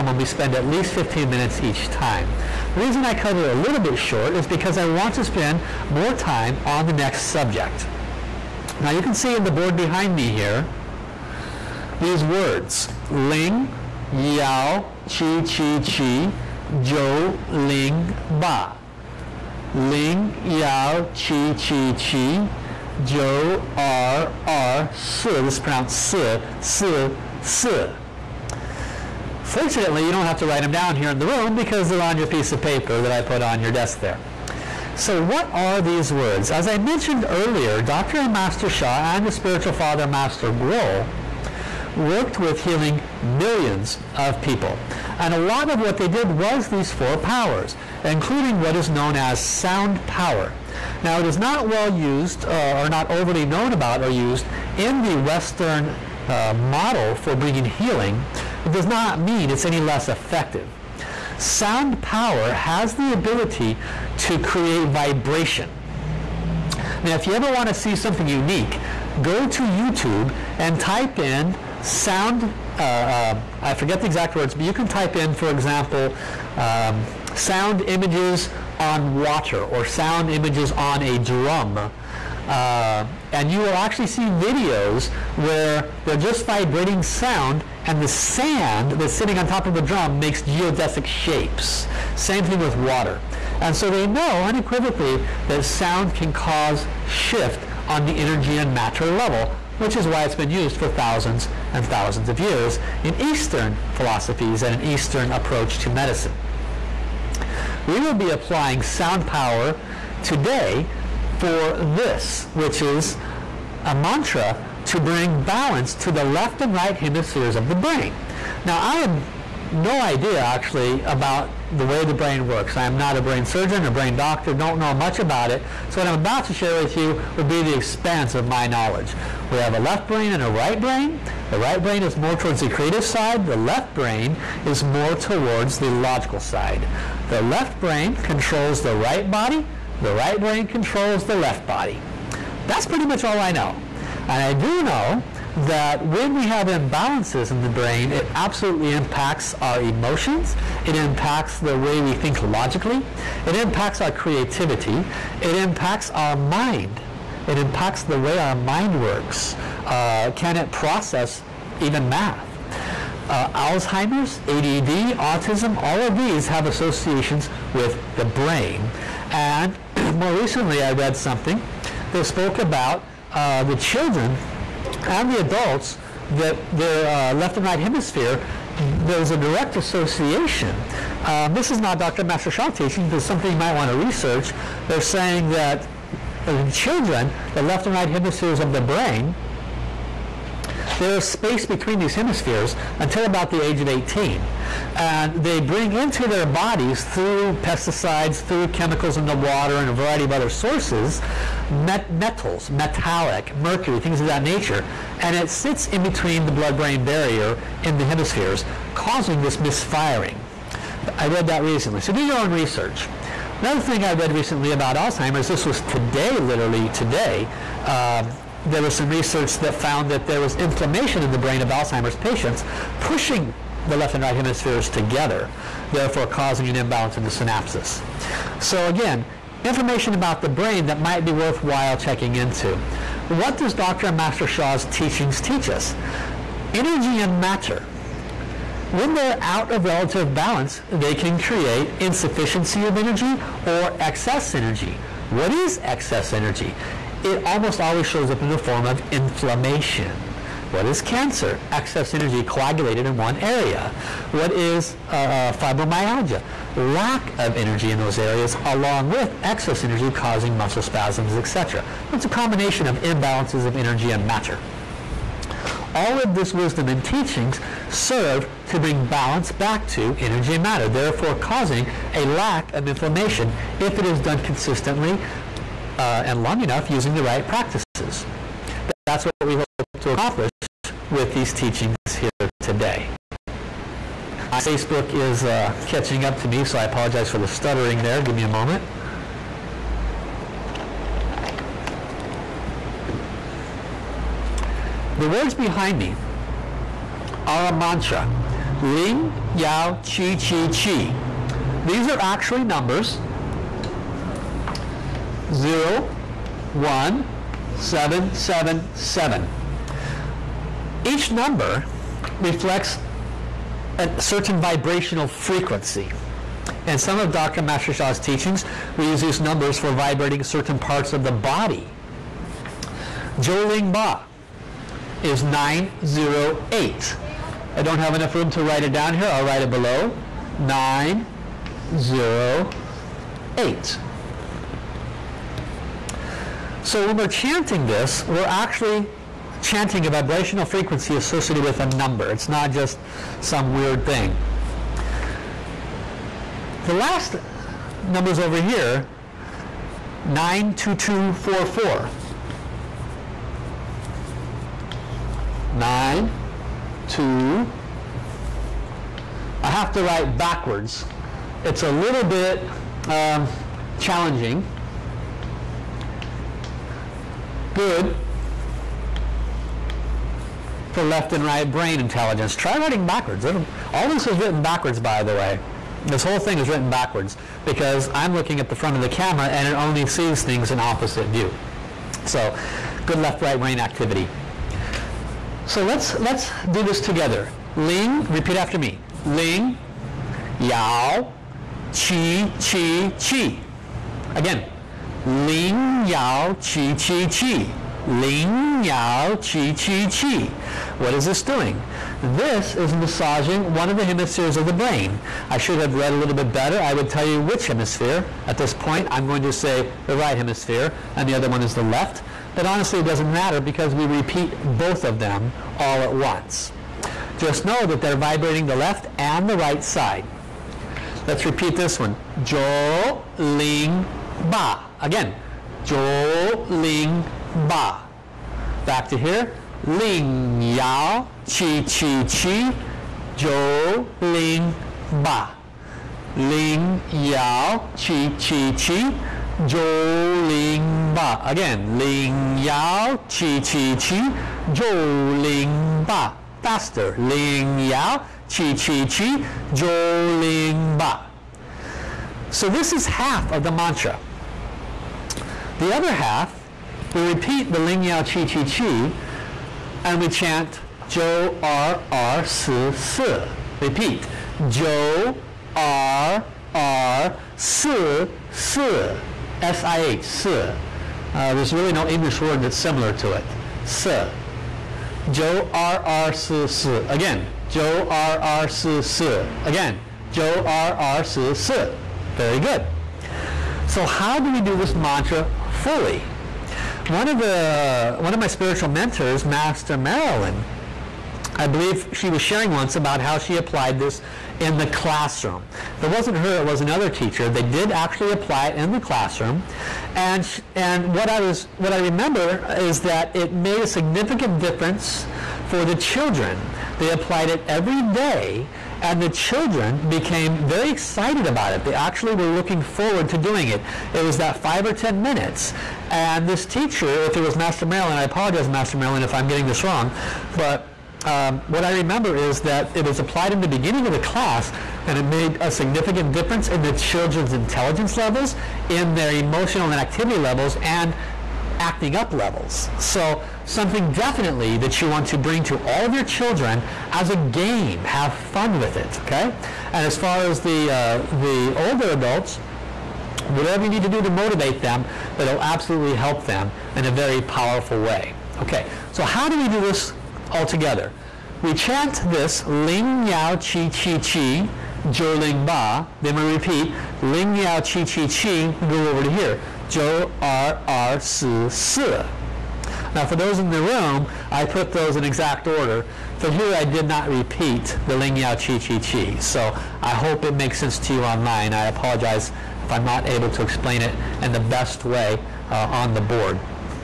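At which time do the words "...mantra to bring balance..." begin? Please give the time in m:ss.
1:53.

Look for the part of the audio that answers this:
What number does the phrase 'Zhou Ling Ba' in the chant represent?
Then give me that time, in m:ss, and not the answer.
5:30.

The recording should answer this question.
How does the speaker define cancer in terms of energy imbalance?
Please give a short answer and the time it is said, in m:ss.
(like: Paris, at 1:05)
excess energy coagulated in one area, at 4:11.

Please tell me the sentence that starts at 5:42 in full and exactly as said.
It's not just some weird thing.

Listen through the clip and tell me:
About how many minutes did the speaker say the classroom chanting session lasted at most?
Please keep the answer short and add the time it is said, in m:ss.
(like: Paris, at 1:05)
10, at 8:34.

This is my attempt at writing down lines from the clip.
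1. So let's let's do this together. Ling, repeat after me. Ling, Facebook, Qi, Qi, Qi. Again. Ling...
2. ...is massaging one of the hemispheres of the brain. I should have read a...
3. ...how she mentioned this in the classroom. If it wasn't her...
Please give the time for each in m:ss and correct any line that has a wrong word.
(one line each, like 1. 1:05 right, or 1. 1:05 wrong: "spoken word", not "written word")
1. 6:25 wrong: "Yao", not "Facebook"
2. 6:42 right
3. 8:13 wrong: "applied", not "mentioned".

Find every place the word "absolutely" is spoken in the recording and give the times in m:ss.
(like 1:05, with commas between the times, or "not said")
2:28, 9:05.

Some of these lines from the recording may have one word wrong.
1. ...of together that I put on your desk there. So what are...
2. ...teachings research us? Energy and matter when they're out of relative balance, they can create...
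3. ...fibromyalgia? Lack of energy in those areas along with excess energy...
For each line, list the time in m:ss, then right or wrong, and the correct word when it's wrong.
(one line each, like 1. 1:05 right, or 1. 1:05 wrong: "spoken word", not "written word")
1. 0:32 wrong: "paper", not "together"
2. 3:54 wrong: "teach", not "research"
3. 4:15 right.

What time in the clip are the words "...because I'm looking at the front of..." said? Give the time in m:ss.
6:17.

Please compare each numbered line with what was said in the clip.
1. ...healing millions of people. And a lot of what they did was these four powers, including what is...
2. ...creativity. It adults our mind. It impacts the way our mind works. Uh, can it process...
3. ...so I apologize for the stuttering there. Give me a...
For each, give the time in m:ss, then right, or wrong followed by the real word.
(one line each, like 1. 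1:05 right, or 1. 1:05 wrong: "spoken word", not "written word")
1. 0:42 right
2. 2:34 wrong: "impacts", not "adults"
3. 4:46 right.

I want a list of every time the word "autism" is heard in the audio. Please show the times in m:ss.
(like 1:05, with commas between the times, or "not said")
2:45.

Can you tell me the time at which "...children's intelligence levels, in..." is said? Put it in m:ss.
8:46.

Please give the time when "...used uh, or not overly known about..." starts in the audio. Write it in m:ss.
0:51.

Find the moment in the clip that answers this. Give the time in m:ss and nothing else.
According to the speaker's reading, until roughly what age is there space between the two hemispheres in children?
3:13.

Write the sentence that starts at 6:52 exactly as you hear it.
But honestly, it doesn't matter because we repeat both of them all at once.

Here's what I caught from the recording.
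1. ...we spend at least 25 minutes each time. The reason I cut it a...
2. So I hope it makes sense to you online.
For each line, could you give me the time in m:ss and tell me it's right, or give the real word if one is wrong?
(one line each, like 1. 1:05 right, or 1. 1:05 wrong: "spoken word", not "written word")
1. 0:00 wrong: "15", not "25"
2. 9:29 right.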